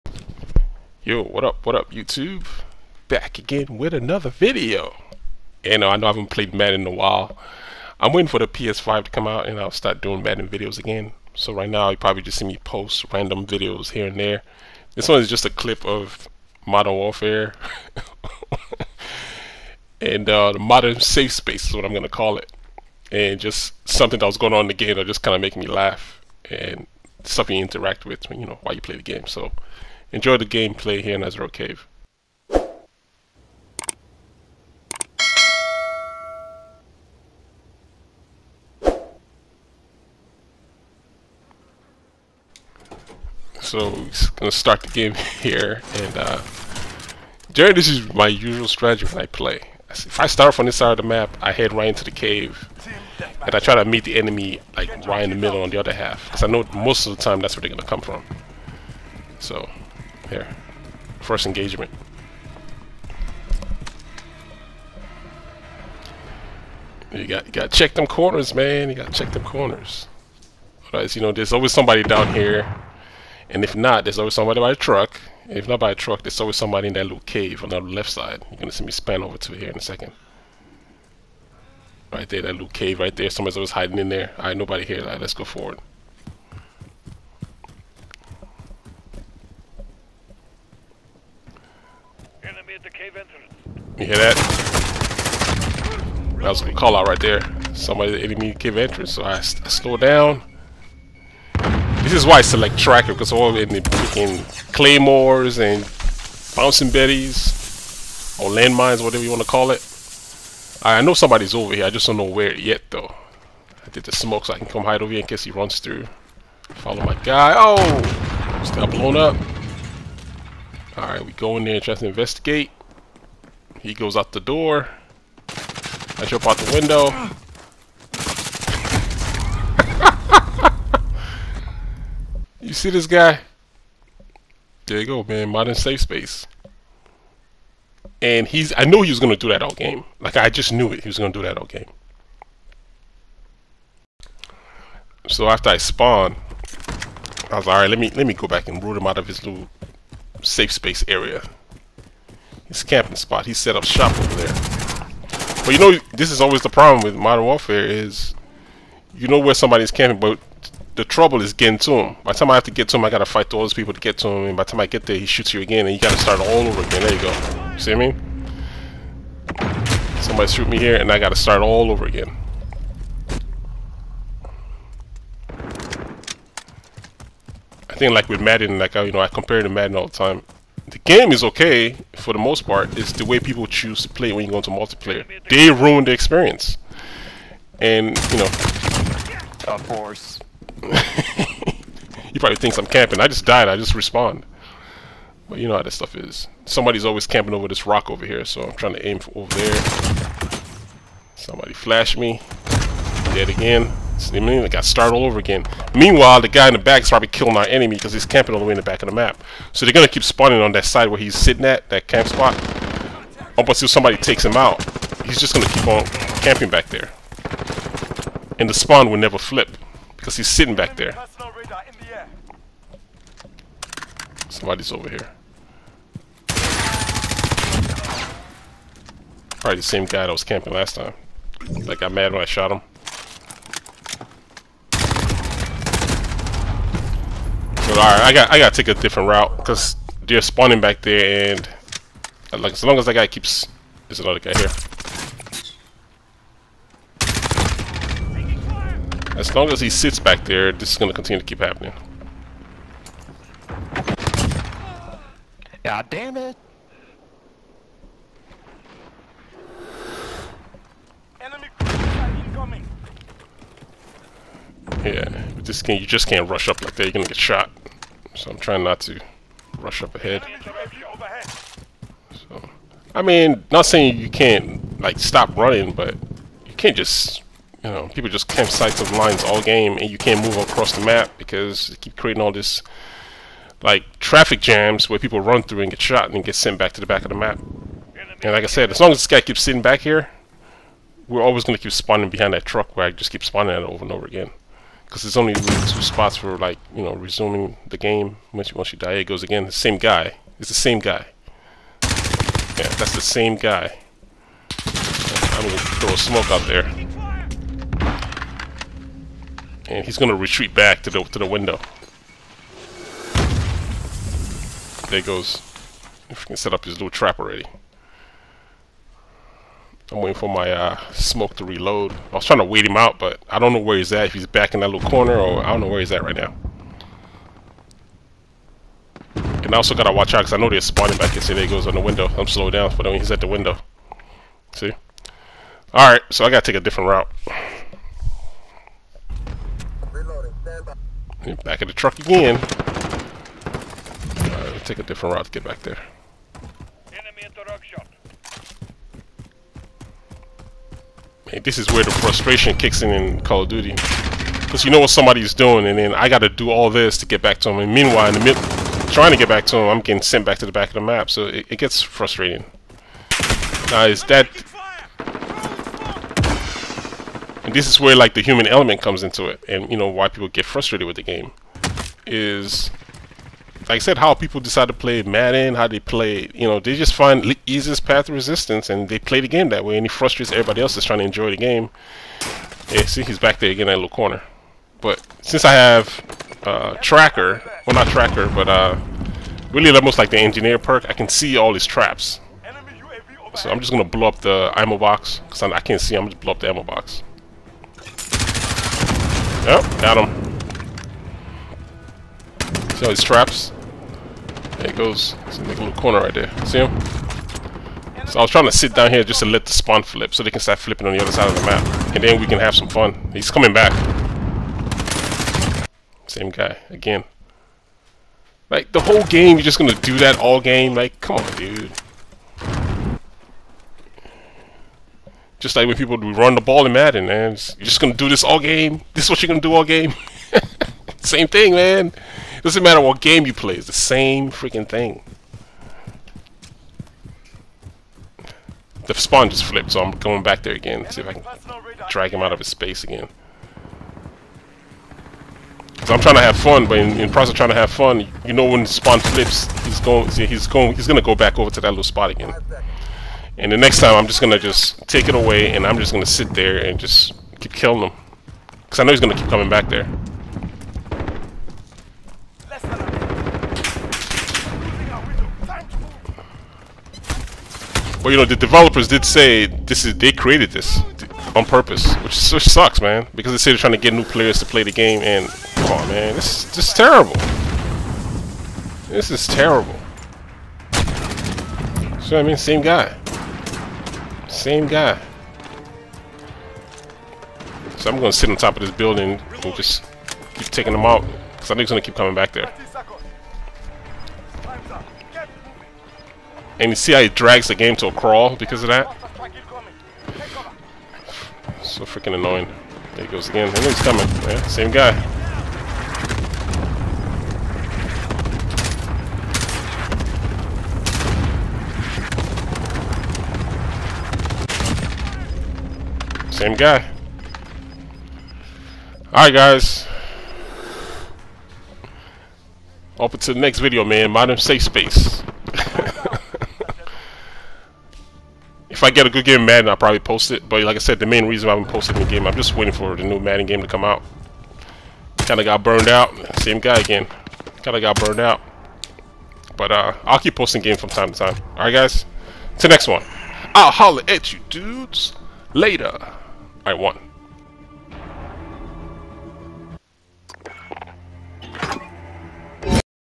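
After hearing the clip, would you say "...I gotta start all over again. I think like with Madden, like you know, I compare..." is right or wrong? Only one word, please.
right.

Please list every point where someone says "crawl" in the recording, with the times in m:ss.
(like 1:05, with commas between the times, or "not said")
8:18.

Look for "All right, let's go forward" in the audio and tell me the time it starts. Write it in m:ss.
1:25.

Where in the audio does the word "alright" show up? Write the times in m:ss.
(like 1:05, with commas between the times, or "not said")
2:00, 2:27, 3:58, 5:35, 8:39, 9:01.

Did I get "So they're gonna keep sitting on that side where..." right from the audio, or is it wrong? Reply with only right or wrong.
wrong.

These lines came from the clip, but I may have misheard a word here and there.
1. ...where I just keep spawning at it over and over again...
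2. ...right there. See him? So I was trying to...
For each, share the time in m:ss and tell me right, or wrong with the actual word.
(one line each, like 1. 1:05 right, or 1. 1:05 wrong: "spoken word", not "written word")
1. 4:52 right
2. 6:46 right.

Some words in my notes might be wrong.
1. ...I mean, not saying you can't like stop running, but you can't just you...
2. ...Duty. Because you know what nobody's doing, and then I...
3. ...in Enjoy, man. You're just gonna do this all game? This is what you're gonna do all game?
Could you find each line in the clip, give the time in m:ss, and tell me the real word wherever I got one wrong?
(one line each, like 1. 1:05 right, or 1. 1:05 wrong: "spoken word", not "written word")
1. 4:33 right
2. 5:53 wrong: "somebody", not "nobody"
3. 7:06 wrong: "Madden", not "Enjoy".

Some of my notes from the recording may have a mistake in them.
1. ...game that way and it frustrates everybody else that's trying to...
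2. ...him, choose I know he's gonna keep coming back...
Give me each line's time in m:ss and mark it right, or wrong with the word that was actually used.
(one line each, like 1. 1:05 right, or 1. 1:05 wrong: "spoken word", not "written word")
1. 6:19 right
2. 7:38 wrong: "cause", not "choose".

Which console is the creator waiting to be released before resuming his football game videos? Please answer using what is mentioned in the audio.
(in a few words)
PS5.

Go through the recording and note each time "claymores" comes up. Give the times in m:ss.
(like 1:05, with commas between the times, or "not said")
1:44.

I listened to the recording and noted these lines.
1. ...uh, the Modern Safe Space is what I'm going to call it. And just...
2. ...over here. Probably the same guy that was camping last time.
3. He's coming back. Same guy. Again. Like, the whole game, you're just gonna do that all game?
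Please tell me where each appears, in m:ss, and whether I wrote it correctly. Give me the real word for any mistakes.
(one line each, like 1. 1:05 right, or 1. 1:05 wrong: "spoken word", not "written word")
1. 0:20 right
2. 3:44 right
3. 6:53 right.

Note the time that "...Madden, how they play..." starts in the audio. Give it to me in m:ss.
6:15.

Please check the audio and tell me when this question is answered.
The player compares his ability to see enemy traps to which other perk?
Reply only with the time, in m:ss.
6:30.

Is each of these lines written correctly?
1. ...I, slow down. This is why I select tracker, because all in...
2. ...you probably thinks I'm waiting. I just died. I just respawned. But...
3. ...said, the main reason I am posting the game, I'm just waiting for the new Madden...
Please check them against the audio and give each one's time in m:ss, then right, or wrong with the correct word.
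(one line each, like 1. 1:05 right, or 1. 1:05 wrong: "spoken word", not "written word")
1. 1:39 right
2. 3:10 wrong: "camping", not "waiting"
3. 8:50 right.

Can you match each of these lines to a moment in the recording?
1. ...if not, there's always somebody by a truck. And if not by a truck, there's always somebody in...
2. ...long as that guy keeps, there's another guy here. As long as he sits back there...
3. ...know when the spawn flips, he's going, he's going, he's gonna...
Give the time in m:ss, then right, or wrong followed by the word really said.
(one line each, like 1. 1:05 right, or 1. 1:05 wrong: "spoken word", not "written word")
1. 1:13 right
2. 4:02 right
3. 7:28 right.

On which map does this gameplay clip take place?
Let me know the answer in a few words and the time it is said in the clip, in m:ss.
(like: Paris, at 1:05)
Azhir Cave, at 0:31.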